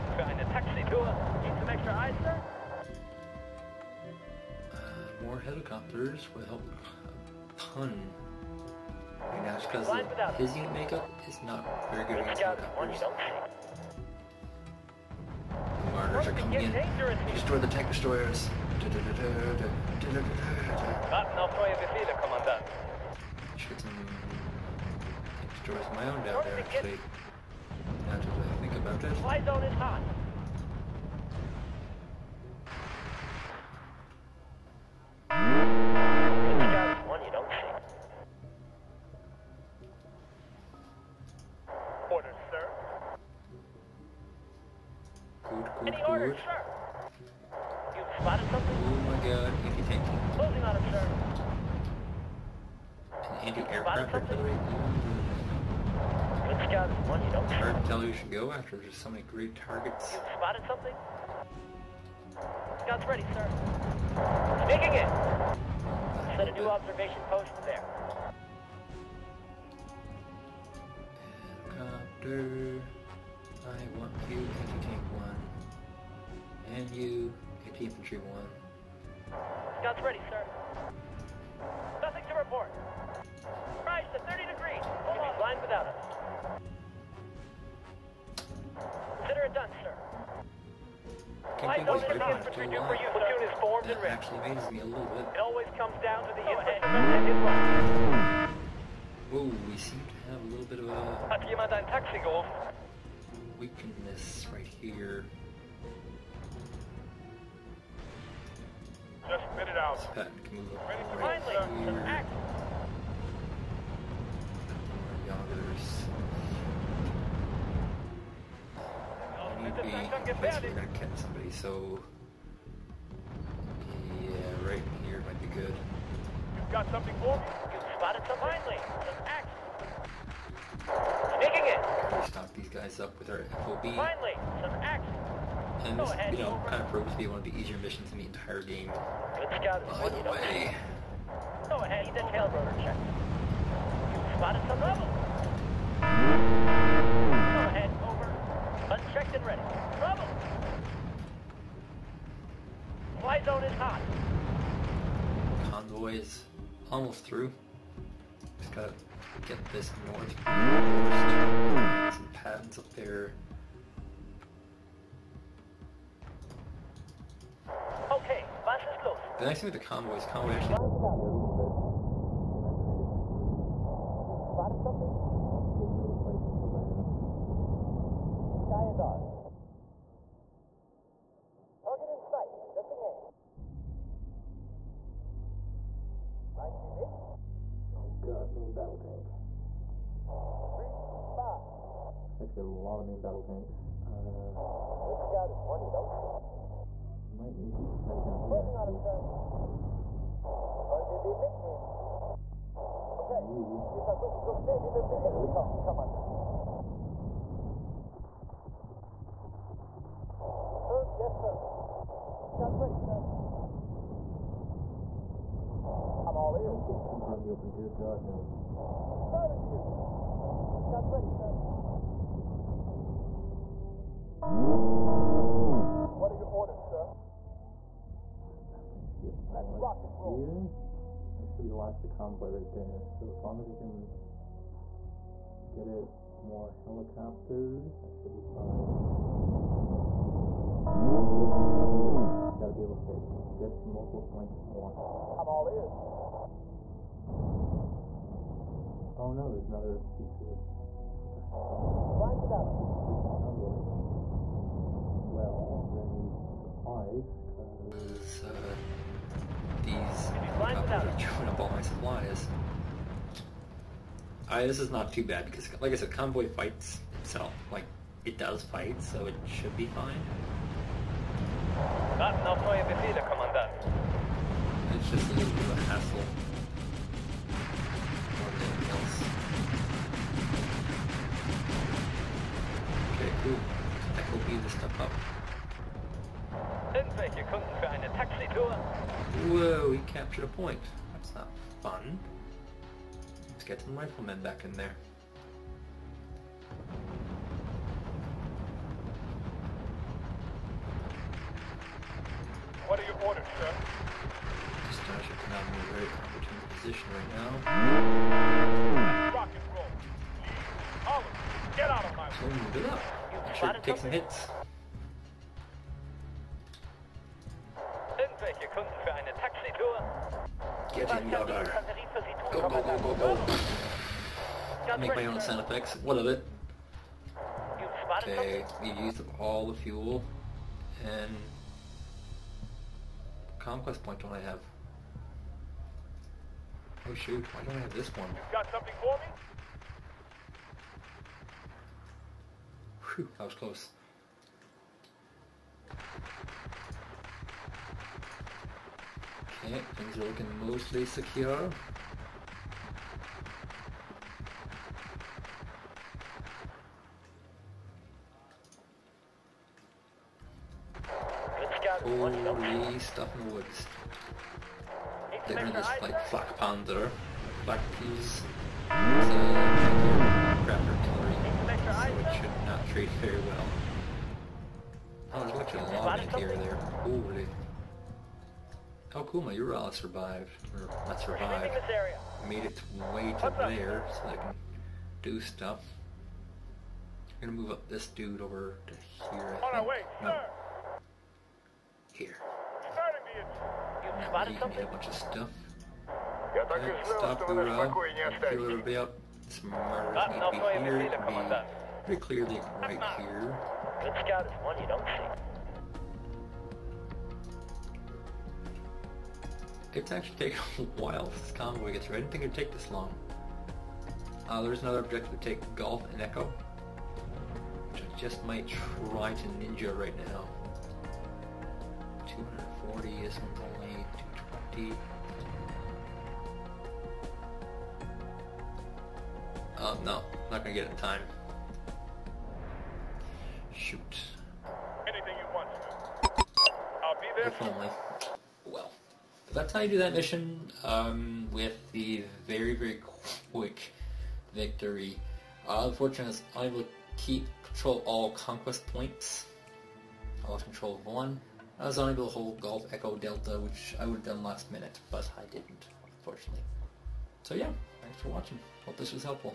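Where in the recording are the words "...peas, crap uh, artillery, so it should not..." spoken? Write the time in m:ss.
6:07.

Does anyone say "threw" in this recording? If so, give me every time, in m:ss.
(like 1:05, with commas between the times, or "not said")
not said.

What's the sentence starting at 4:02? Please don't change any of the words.
It's gotta be able to hit good to multiple points at once.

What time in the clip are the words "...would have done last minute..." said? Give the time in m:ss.
7:34.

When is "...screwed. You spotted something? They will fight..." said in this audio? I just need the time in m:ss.
2:53.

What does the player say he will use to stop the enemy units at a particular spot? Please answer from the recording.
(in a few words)
Our FOB.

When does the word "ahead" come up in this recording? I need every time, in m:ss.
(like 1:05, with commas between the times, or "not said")
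2:16, 2:21.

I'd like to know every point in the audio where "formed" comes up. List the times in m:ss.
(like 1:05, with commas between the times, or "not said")
1:33.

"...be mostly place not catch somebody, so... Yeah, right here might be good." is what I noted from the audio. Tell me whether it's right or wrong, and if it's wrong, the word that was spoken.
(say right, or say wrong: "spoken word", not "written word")
wrong: "basically", not "mostly".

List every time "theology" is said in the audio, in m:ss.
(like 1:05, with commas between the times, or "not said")
not said.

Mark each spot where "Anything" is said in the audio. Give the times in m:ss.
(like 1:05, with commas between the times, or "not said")
7:15.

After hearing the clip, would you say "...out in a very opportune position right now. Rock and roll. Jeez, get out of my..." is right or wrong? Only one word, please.
right.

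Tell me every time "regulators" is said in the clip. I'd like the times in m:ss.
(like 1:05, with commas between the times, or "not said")
not said.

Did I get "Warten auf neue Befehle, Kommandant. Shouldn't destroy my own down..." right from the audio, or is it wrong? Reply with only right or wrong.
right.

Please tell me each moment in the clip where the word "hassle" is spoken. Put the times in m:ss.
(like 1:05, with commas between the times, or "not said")
4:35.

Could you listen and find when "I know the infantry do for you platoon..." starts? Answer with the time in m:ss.
1:31.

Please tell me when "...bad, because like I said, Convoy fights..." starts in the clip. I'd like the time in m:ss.
4:25.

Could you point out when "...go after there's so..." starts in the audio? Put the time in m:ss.
0:58.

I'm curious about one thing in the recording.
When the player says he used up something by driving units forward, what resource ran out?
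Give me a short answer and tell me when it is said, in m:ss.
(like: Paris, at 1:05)
Fuel, at 5:29.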